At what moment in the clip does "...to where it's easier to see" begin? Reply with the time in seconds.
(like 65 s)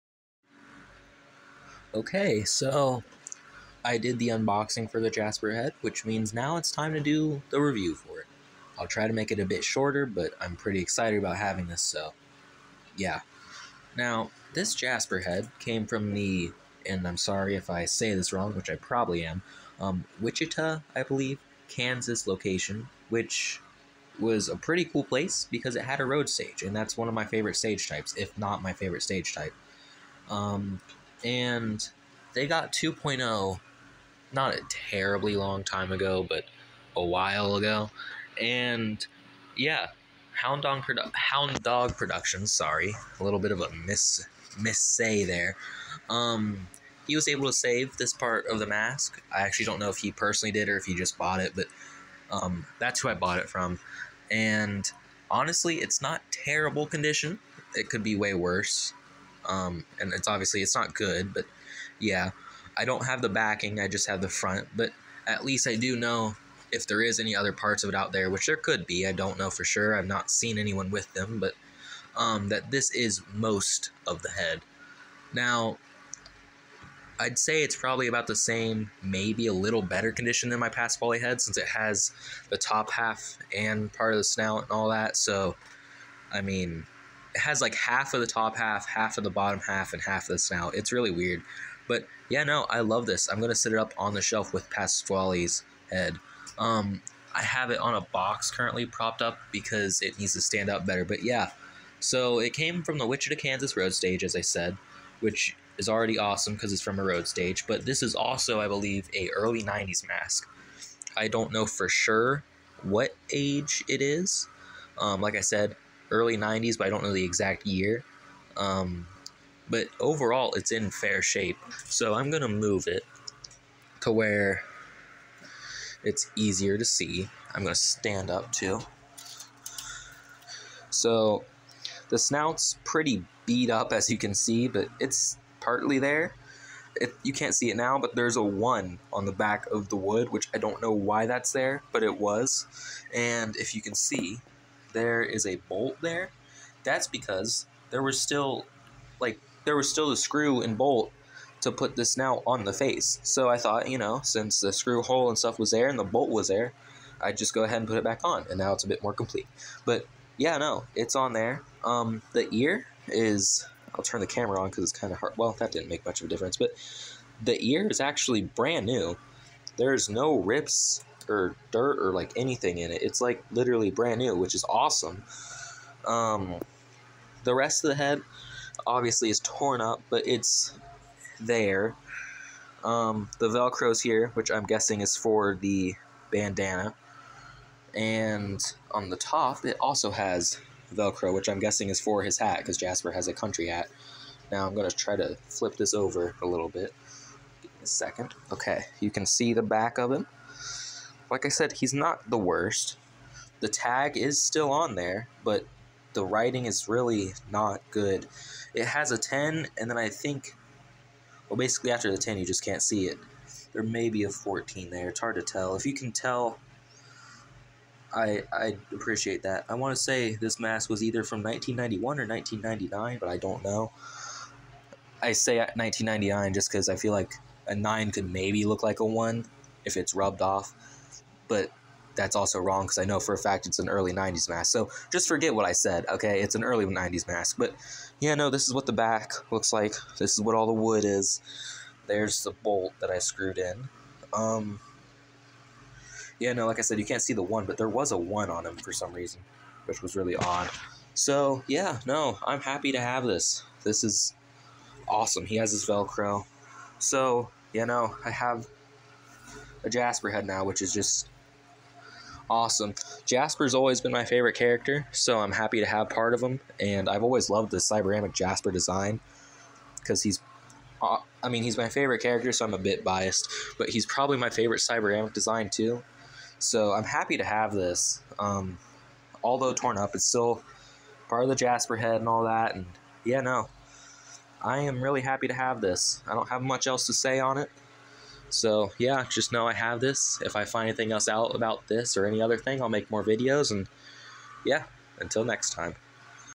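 124 s.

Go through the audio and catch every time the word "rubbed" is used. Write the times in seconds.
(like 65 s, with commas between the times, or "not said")
230 s.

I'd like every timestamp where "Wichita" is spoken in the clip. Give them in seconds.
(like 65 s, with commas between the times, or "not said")
20 s, 103 s.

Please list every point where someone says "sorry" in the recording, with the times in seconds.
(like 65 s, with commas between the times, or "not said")
17 s, 42 s.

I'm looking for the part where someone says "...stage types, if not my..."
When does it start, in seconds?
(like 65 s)
27 s.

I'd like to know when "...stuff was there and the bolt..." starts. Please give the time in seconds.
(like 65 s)
155 s.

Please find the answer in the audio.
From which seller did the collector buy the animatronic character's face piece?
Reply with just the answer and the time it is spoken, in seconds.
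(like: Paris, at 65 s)
Hound Dog Productions, at 41 s.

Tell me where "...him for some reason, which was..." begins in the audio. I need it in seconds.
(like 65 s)
248 s.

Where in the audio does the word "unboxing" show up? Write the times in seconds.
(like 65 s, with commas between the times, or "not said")
4 s.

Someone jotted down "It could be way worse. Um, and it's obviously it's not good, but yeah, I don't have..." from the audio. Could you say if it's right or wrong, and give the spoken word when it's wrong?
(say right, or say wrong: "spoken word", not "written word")
right.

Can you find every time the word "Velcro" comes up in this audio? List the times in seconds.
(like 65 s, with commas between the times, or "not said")
183 s, 190 s, 255 s.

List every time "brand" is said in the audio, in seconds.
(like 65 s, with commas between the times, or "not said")
168 s, 173 s.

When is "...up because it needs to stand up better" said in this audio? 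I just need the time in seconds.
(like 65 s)
99 s.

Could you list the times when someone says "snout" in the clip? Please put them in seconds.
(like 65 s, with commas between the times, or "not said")
84 s, 90 s, 132 s.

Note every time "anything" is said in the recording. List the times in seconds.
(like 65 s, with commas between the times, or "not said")
172 s, 290 s.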